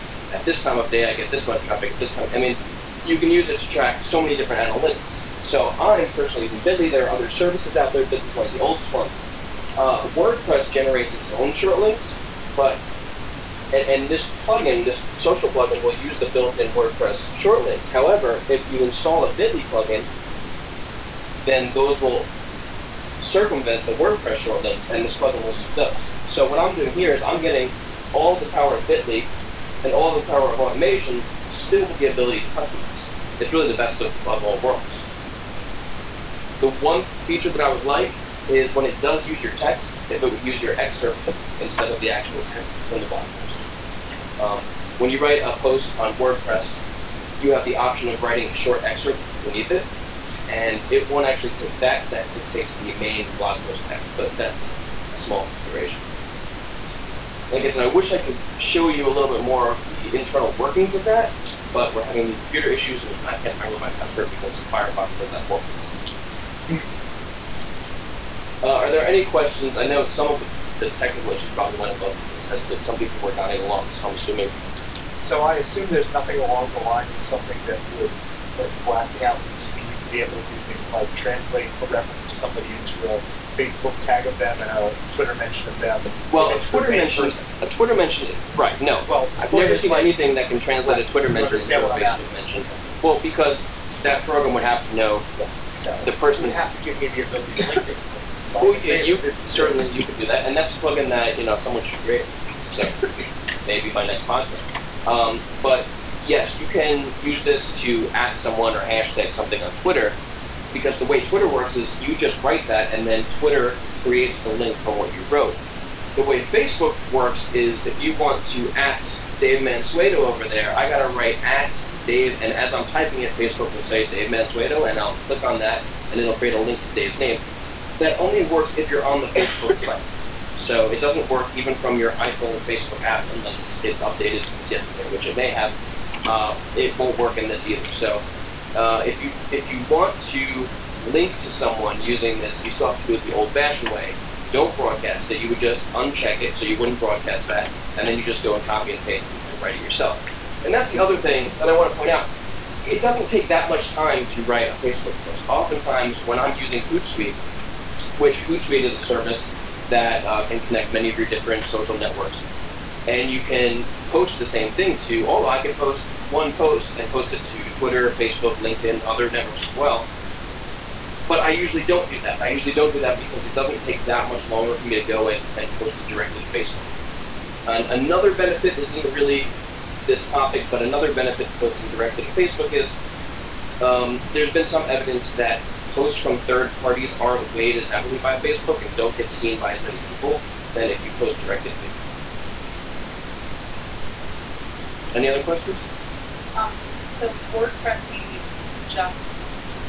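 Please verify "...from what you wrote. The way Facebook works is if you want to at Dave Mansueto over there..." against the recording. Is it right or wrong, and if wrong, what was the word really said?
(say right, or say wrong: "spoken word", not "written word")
right.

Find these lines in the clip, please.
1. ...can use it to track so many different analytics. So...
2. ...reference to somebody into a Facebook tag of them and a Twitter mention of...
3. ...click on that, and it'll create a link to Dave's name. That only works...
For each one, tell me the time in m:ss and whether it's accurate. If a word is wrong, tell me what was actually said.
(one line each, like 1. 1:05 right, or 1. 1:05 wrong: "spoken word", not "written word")
1. 0:03 right
2. 1:21 right
3. 2:05 right.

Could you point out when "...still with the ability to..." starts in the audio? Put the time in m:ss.
0:31.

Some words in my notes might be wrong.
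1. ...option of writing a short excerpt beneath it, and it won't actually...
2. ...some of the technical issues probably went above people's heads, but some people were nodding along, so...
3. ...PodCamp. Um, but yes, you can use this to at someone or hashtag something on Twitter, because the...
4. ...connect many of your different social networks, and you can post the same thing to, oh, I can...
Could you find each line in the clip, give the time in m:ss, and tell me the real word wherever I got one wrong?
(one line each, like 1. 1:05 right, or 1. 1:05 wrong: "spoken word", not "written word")
1. 0:47 right
2. 1:10 right
3. 1:44 right
4. 2:40 right.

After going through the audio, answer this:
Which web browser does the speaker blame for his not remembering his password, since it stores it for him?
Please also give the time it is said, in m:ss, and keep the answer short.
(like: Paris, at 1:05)
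Firefox, at 1:04.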